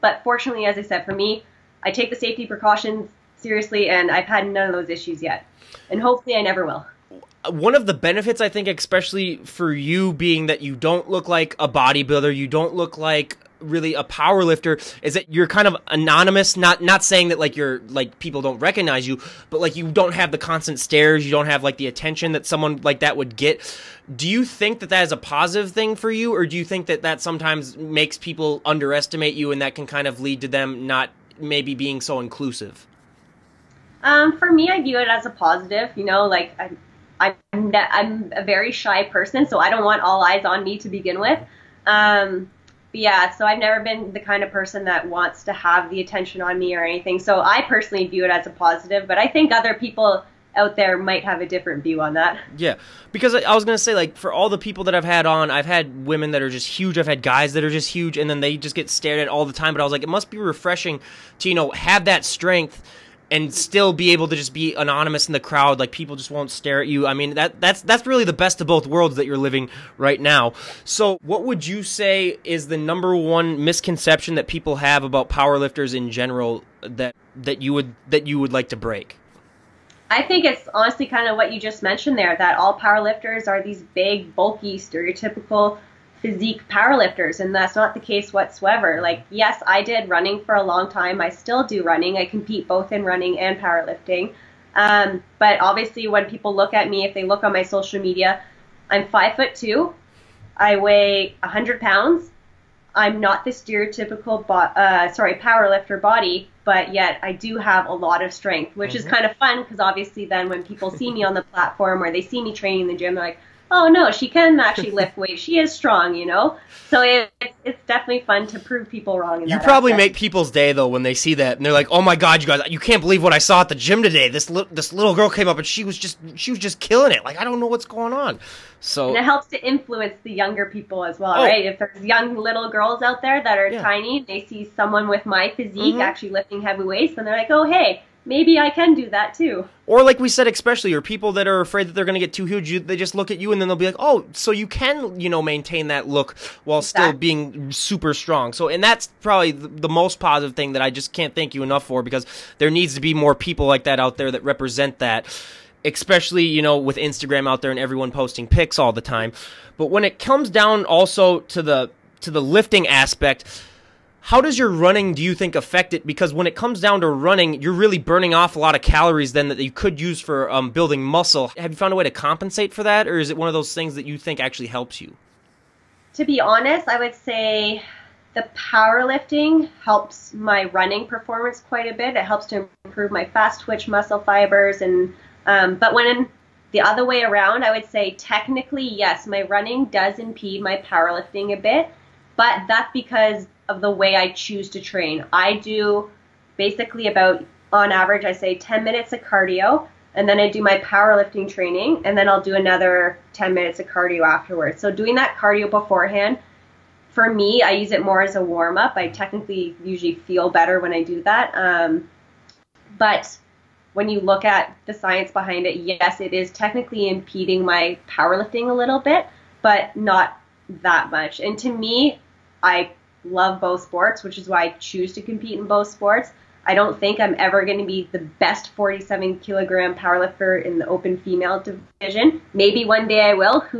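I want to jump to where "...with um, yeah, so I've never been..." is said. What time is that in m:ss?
0:41.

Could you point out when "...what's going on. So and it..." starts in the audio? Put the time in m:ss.
2:07.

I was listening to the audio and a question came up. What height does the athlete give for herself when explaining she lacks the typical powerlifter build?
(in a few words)
5 foot 2.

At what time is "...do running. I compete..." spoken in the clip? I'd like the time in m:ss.
1:31.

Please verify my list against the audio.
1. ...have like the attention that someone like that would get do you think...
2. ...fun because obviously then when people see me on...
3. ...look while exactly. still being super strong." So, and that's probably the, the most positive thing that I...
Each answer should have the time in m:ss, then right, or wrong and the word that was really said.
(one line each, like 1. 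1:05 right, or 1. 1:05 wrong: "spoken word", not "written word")
1. 0:21 right
2. 1:49 right
3. 2:26 right.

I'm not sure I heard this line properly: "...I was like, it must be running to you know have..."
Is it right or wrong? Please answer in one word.
wrong.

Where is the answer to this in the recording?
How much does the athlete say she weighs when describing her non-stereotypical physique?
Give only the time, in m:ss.
1:41.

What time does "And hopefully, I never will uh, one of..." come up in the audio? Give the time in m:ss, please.
0:05.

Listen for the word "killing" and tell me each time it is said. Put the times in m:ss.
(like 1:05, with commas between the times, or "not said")
2:06.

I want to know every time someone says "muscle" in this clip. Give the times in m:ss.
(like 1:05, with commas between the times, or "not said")
2:51, 3:03.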